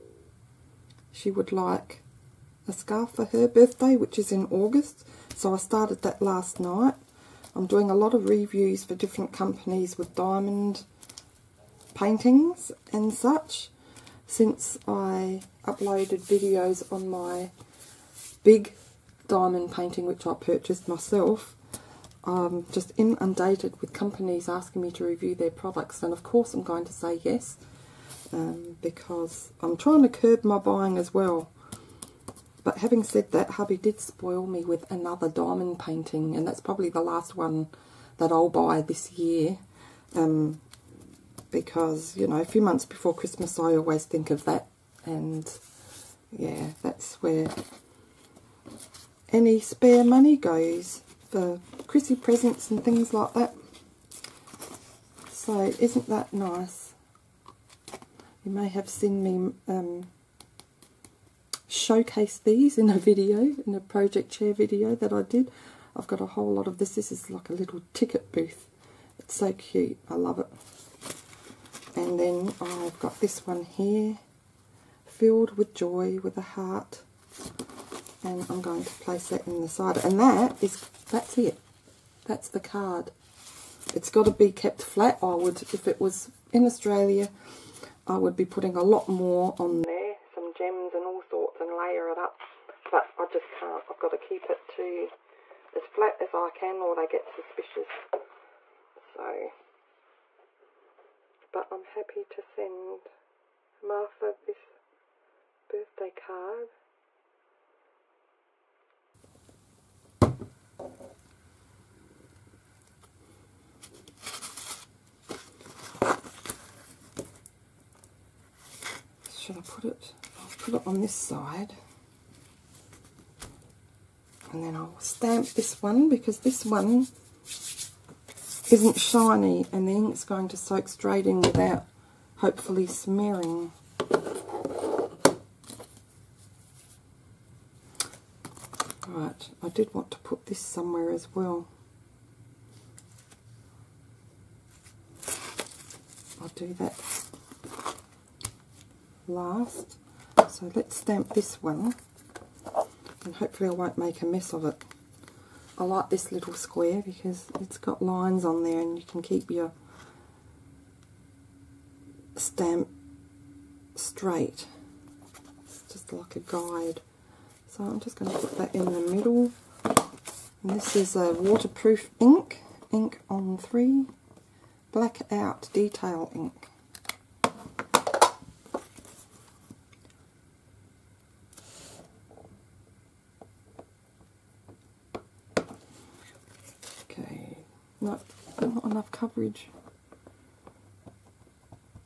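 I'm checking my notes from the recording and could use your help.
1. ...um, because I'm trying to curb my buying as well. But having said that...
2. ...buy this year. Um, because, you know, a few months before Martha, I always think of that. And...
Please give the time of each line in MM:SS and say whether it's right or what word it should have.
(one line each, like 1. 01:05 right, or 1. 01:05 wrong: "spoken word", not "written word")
1. 00:28 right
2. 00:38 wrong: "Christmas", not "Martha".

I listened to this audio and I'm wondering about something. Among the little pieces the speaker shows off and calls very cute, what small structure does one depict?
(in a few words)
Ticket booth.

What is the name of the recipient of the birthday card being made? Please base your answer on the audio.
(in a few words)
Martha.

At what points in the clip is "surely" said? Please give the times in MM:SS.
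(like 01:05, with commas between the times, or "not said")
not said.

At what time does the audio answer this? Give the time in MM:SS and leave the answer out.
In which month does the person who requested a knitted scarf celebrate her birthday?
00:04.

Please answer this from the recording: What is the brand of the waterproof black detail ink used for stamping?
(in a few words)
Inkon3.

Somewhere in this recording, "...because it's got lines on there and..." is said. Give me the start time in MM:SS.
02:37.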